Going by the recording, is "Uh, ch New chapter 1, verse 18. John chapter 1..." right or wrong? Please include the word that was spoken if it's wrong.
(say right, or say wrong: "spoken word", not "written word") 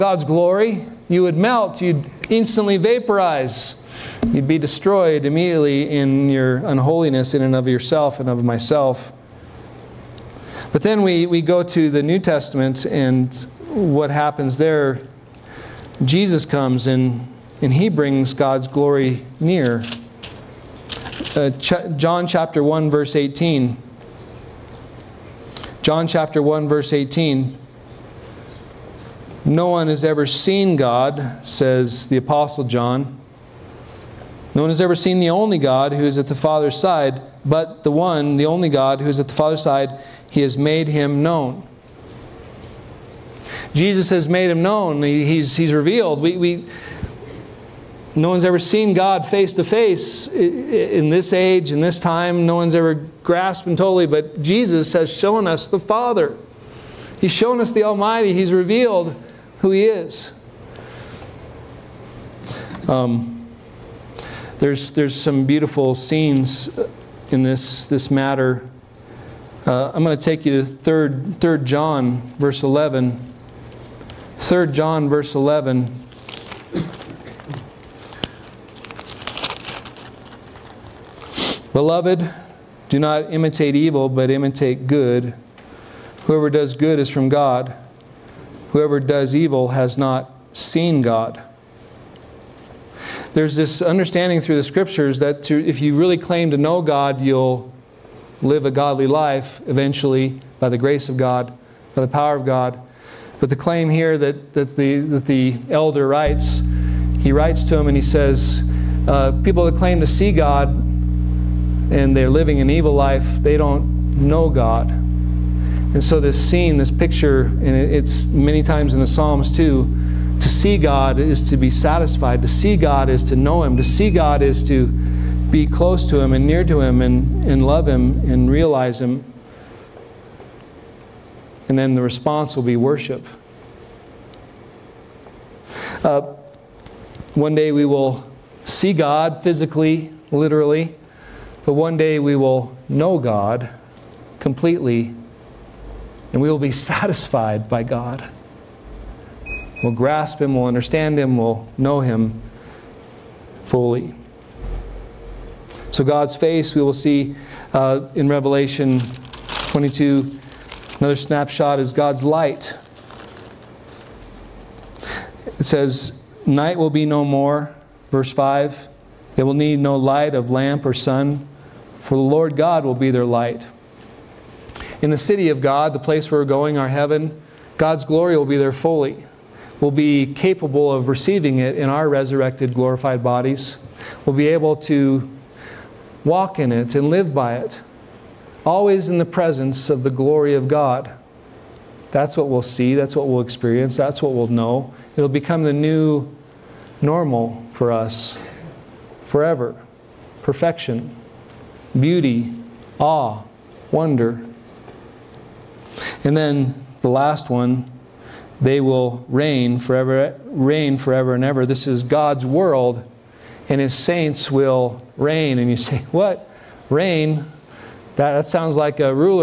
wrong: "John", not "New".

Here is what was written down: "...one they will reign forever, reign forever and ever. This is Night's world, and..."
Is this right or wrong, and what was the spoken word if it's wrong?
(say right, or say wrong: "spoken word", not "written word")
wrong: "God", not "Night".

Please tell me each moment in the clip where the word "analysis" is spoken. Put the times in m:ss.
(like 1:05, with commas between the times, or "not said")
not said.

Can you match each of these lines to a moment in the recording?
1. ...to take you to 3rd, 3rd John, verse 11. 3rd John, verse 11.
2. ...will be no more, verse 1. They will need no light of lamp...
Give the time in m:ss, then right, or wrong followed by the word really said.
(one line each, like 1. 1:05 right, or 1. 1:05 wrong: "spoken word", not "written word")
1. 1:10 right
2. 2:46 wrong: "5", not "1".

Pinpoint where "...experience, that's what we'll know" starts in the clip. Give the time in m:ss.
3:13.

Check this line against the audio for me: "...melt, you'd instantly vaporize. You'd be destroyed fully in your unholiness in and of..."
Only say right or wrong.
wrong.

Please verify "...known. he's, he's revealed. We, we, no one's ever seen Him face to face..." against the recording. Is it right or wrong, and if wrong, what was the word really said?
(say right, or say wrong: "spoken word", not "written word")
wrong: "God", not "Him".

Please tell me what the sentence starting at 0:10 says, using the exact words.
But then we, we go to the New Testament and what happens there.